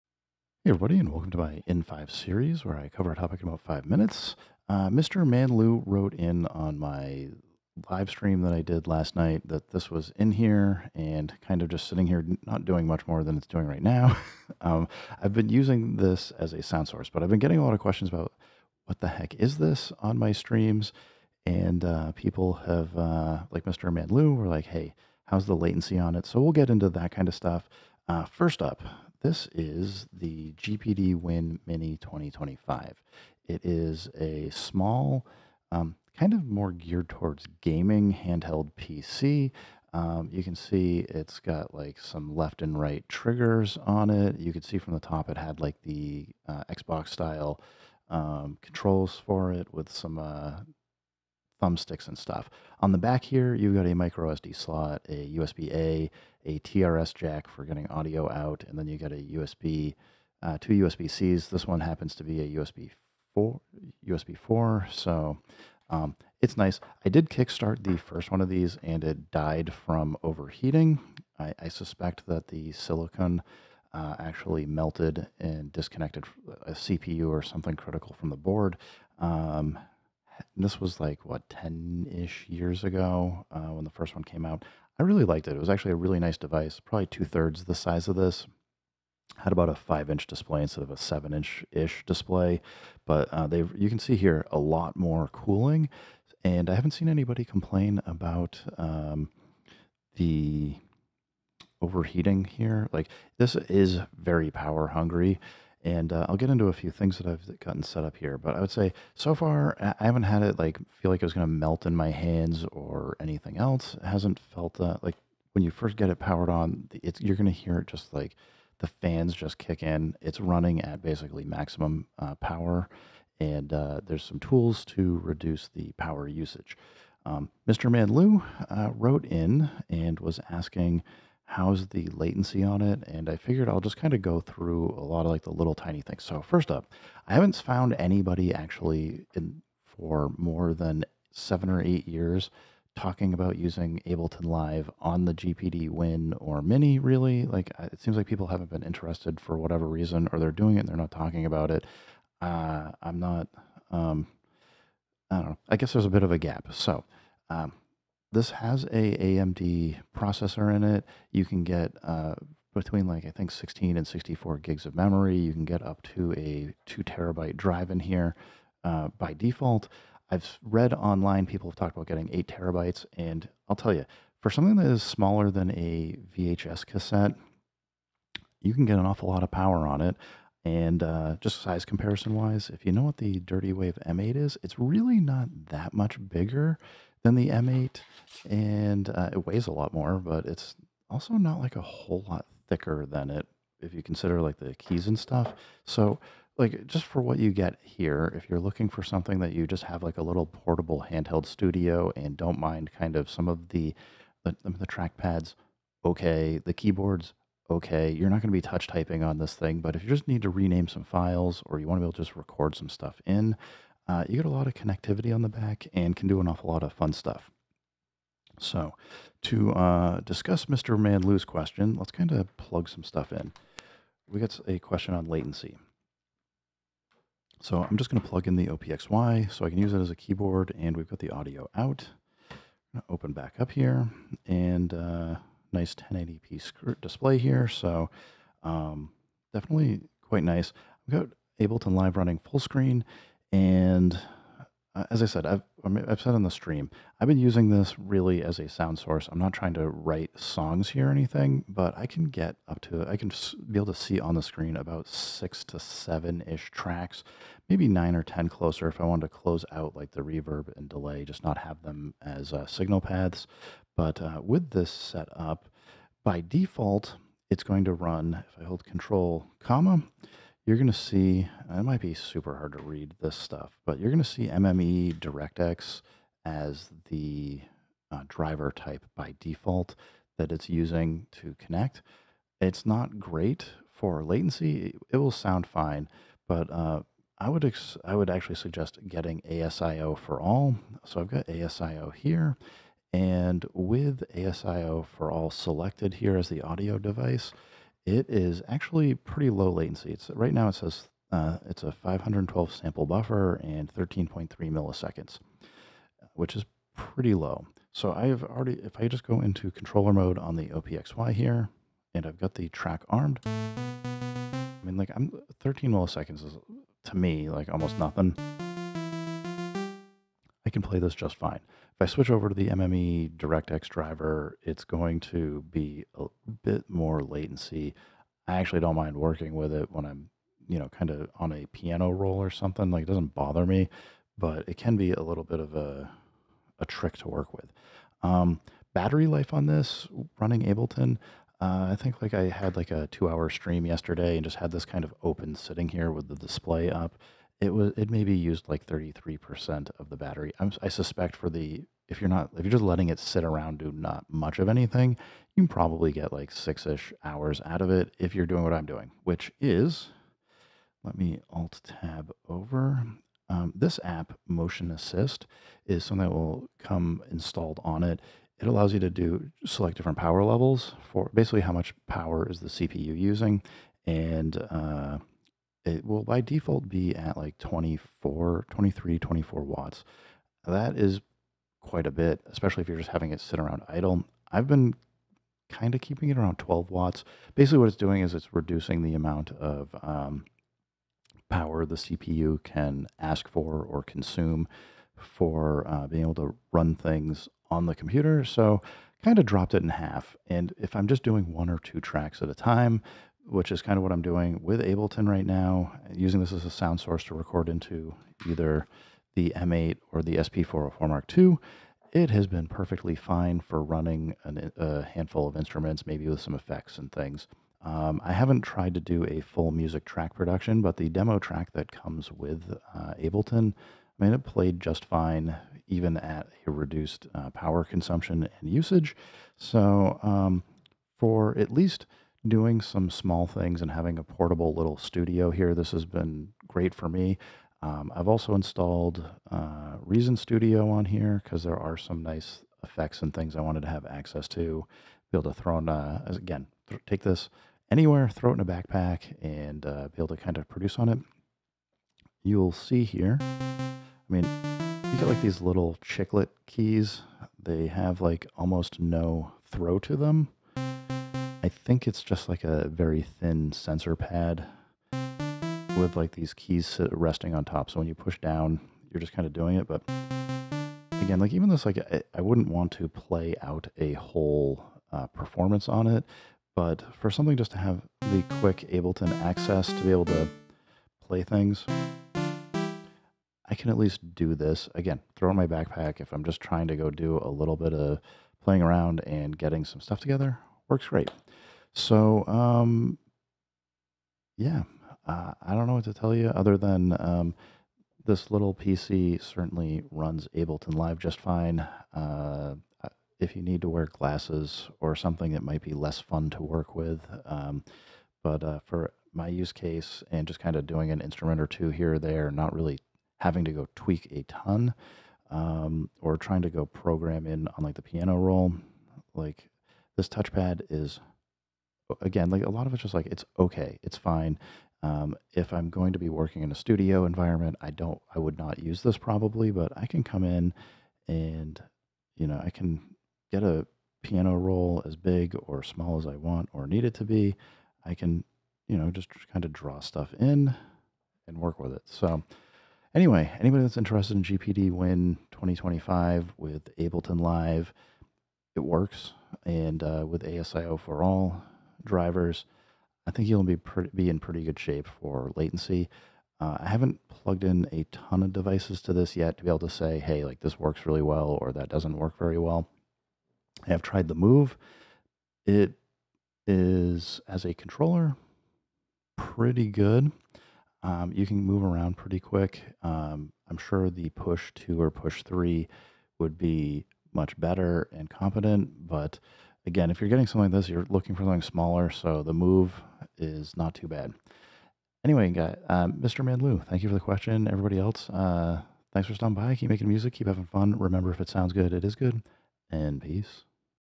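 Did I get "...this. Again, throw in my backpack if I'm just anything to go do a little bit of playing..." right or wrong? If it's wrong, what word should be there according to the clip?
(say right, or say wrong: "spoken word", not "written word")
wrong: "trying", not "anything".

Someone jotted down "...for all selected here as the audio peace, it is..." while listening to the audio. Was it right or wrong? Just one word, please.
wrong.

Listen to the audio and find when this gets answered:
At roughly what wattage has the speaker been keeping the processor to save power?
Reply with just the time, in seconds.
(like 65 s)
386 s.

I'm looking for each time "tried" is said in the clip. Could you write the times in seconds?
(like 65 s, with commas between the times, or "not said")
418 s, 564 s.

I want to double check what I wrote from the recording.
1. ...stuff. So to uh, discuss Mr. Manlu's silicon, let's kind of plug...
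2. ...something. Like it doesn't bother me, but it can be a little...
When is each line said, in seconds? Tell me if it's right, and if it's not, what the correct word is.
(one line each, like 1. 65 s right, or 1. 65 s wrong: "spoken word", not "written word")
1. 217 s wrong: "question", not "silicon"
2. 332 s right.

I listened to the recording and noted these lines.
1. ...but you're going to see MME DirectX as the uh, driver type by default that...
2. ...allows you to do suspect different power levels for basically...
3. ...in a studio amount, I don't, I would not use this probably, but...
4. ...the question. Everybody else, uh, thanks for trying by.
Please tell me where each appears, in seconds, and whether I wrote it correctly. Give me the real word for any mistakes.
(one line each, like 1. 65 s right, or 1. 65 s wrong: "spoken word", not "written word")
1. 273 s right
2. 368 s wrong: "select", not "suspect"
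3. 526 s wrong: "environment", not "amount"
4. 587 s wrong: "stopping", not "trying".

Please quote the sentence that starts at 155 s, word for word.
I guess there's a bit of a gap.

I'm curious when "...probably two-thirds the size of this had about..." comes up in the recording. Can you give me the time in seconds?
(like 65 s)
86 s.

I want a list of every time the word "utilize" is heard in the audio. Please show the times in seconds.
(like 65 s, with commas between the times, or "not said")
not said.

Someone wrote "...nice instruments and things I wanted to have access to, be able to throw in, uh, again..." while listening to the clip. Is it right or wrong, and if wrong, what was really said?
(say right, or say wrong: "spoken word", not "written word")
wrong: "effects", not "instruments".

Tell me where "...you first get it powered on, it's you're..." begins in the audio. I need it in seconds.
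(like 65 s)
115 s.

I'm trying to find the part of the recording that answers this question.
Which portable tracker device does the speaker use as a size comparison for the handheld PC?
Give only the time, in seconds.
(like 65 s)
183 s.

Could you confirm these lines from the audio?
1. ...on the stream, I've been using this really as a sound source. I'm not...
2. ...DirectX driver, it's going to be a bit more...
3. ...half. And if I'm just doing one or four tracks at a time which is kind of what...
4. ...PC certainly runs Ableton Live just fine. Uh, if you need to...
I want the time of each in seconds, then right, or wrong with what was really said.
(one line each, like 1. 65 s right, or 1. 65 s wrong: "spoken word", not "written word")
1. 246 s right
2. 323 s right
3. 399 s wrong: "two", not "four"
4. 498 s right.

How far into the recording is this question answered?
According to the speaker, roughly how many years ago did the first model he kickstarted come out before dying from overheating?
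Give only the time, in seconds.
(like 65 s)
81 s.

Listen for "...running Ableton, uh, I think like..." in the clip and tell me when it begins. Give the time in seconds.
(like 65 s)
340 s.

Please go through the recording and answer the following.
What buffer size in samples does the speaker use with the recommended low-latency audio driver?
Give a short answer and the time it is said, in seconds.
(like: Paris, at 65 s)
512, at 301 s.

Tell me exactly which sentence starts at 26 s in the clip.
So we'll get into that kind of stuff.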